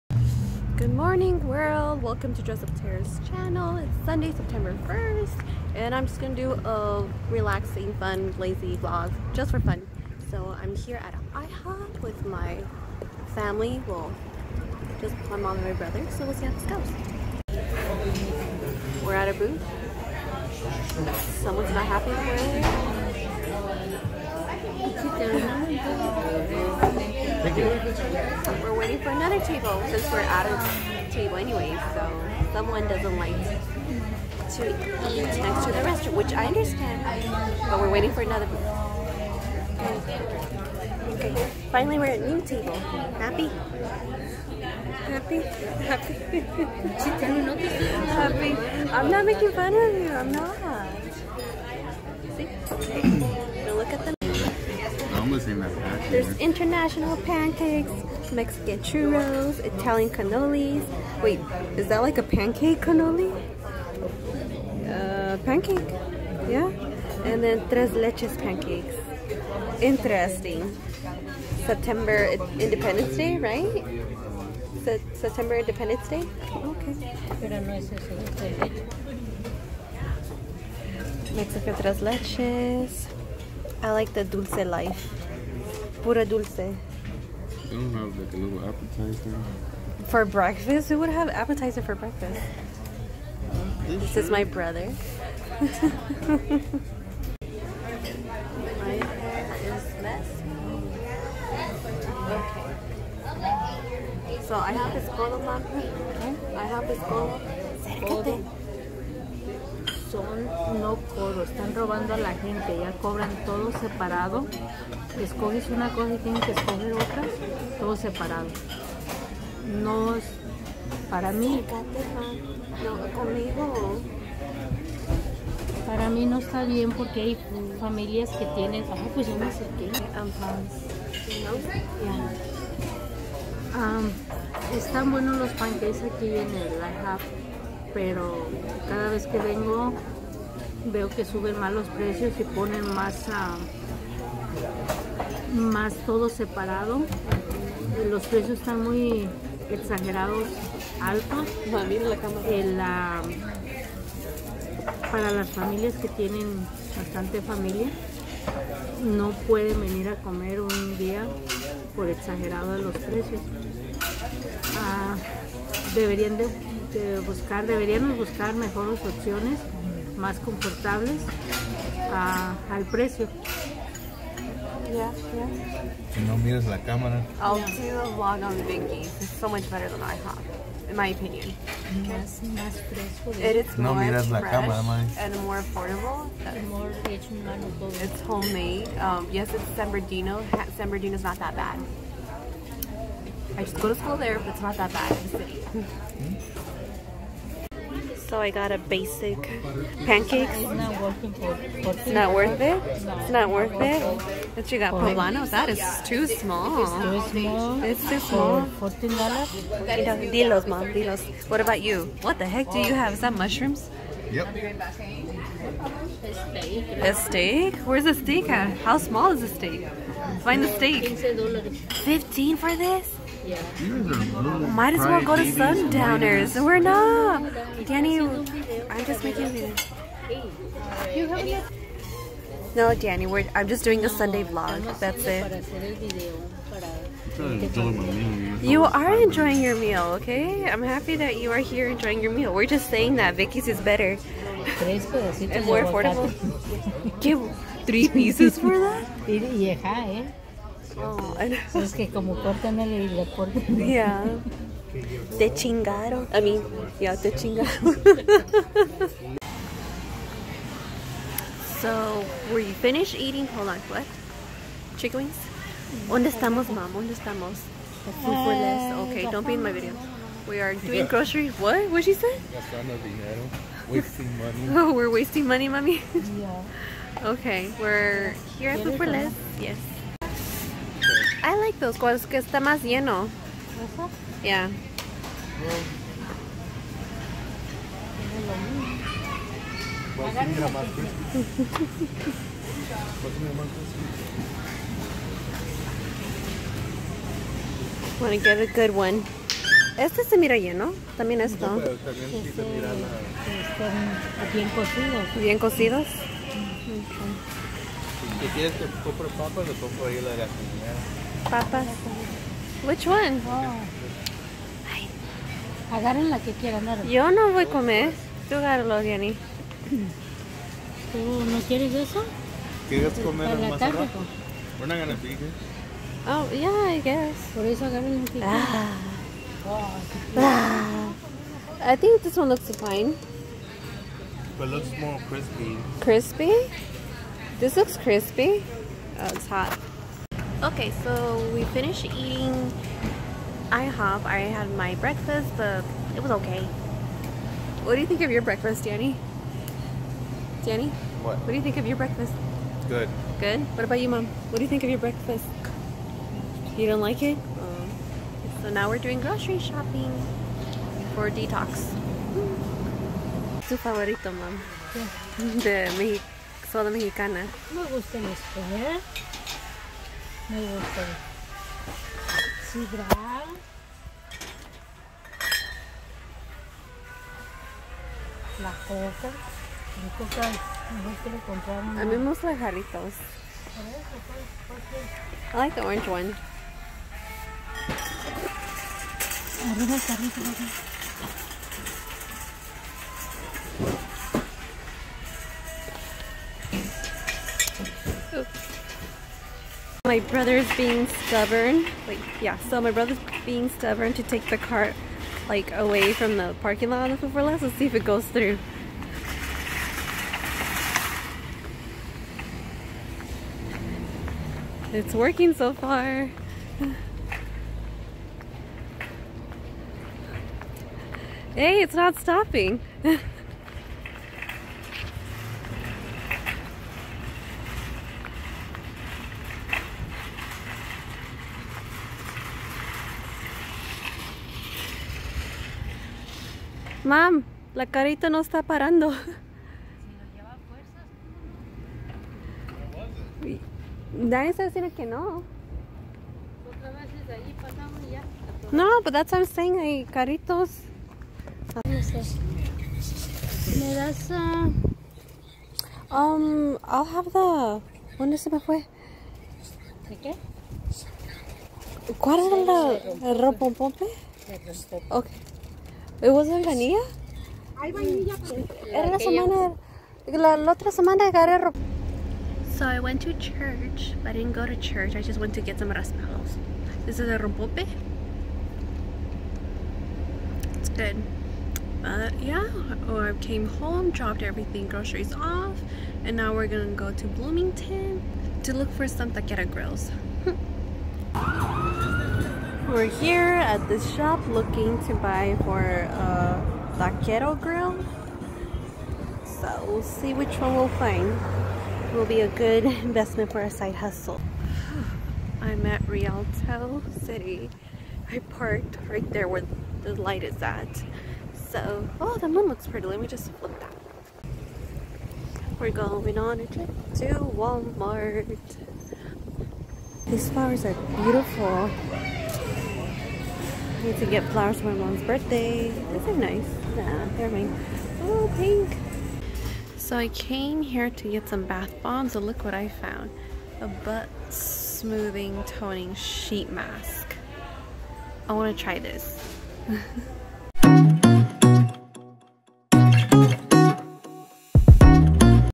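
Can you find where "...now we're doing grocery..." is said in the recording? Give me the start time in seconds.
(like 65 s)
358 s.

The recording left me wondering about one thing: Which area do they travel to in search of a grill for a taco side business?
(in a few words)
Bloomington.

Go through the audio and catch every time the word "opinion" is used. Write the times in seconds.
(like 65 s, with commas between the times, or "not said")
181 s.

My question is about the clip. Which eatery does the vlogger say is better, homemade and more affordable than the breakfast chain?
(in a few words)
Binkies.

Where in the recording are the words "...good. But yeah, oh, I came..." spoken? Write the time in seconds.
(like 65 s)
480 s.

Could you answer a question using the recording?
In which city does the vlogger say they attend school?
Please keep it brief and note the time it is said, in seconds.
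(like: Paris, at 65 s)
San Bernardino, at 193 s.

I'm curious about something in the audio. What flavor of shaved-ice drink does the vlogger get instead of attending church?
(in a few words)
Rompope.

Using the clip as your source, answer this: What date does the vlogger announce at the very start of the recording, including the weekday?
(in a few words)
Sunday, September 1st.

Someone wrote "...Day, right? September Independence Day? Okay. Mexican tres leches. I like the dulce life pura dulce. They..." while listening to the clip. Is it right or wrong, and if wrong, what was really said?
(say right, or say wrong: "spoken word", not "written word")
right.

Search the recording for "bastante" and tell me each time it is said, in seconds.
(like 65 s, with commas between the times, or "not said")
156 s.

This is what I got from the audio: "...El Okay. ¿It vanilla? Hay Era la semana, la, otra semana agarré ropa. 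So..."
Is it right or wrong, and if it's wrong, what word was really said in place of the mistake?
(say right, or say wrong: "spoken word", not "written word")
right.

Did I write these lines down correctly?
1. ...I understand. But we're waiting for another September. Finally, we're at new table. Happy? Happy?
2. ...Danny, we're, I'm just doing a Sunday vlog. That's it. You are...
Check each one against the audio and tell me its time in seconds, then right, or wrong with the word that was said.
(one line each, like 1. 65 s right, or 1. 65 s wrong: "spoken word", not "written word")
1. 36 s wrong: "Okay", not "September"
2. 232 s right.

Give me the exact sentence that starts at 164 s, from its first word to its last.
Ah, deberían de, buscar, deberíamos buscar mejores opciones, más confortables ah, al precio.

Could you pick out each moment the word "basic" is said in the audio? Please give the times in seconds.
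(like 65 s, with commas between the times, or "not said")
198 s.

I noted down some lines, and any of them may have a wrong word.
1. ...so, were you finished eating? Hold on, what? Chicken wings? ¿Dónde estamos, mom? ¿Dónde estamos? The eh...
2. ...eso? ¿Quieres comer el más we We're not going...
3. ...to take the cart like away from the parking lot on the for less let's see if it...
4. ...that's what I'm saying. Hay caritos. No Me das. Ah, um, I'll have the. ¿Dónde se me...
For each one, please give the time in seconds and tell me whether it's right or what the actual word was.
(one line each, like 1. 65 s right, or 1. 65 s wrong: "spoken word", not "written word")
1. 261 s right
2. 321 s right
3. 404 s right
4. 449 s right.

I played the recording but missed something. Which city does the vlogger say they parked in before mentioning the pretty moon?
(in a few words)
Rialto.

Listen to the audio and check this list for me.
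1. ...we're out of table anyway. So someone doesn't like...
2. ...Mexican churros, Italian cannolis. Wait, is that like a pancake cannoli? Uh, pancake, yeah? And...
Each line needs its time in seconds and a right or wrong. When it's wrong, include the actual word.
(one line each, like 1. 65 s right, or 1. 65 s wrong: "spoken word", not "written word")
1. 30 s right
2. 58 s right.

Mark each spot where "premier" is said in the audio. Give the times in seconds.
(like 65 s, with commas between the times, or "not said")
not said.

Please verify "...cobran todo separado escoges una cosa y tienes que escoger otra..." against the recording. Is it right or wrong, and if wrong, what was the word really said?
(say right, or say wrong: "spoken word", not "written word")
right.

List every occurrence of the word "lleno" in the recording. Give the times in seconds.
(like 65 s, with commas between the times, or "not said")
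282 s, 300 s.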